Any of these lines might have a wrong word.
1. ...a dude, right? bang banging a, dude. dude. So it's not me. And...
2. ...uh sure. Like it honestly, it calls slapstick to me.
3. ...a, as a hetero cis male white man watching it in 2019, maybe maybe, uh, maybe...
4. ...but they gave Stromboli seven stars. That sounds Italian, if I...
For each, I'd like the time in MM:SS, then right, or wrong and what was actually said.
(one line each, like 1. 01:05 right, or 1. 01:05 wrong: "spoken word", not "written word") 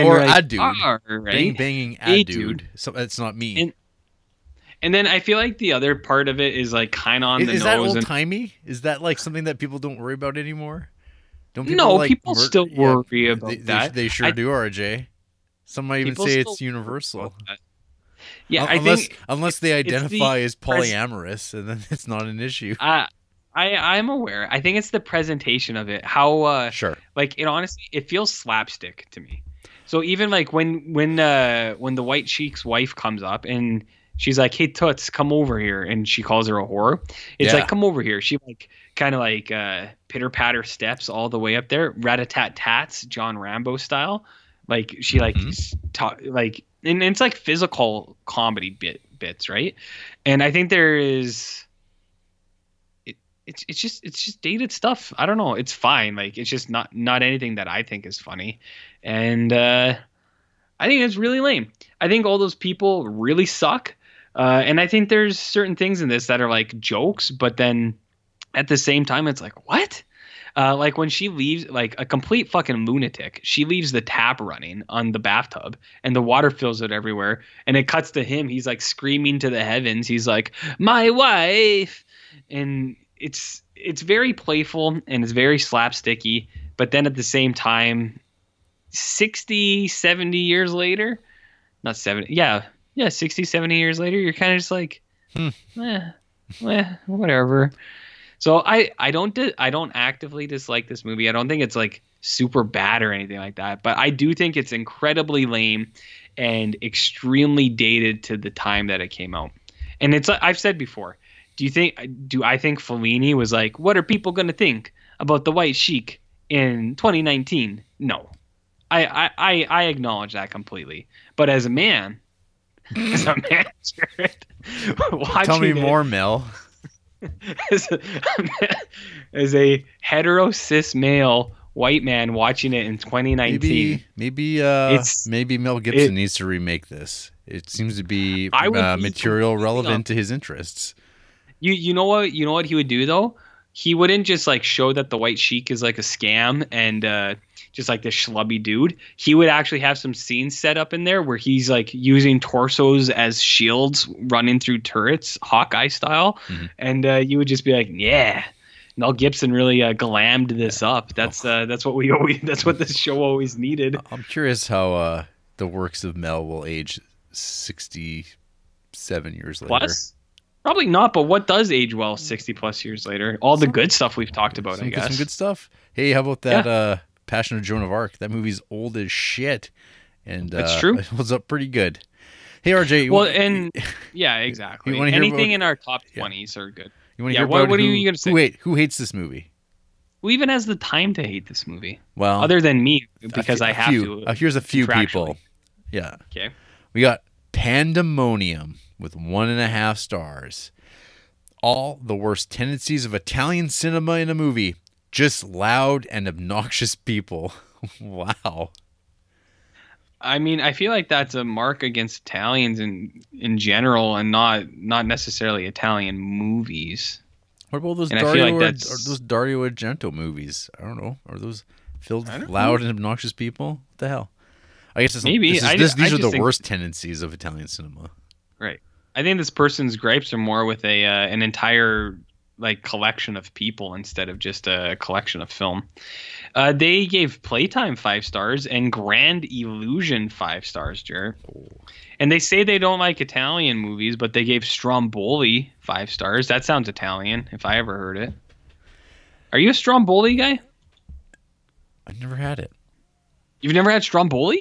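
1. 00:00 right
2. 00:26 wrong: "feels", not "calls"
3. 02:07 right
4. 04:04 wrong: "five", not "seven".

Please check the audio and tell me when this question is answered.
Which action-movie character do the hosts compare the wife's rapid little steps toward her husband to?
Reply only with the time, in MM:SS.
00:43.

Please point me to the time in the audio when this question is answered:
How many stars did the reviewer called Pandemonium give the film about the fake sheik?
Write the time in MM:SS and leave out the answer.
03:19.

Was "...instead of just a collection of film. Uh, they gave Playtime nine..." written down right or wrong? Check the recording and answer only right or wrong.
wrong.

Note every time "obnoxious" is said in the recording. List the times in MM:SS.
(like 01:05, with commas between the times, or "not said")
03:26, 03:42.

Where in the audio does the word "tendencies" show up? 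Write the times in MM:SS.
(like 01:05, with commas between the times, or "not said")
03:22, 03:46.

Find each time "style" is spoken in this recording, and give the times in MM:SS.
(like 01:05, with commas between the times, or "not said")
00:43, 02:35.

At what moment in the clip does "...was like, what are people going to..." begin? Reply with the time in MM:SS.
01:53.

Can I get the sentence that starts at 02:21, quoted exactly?
You you know what you know what he would do though?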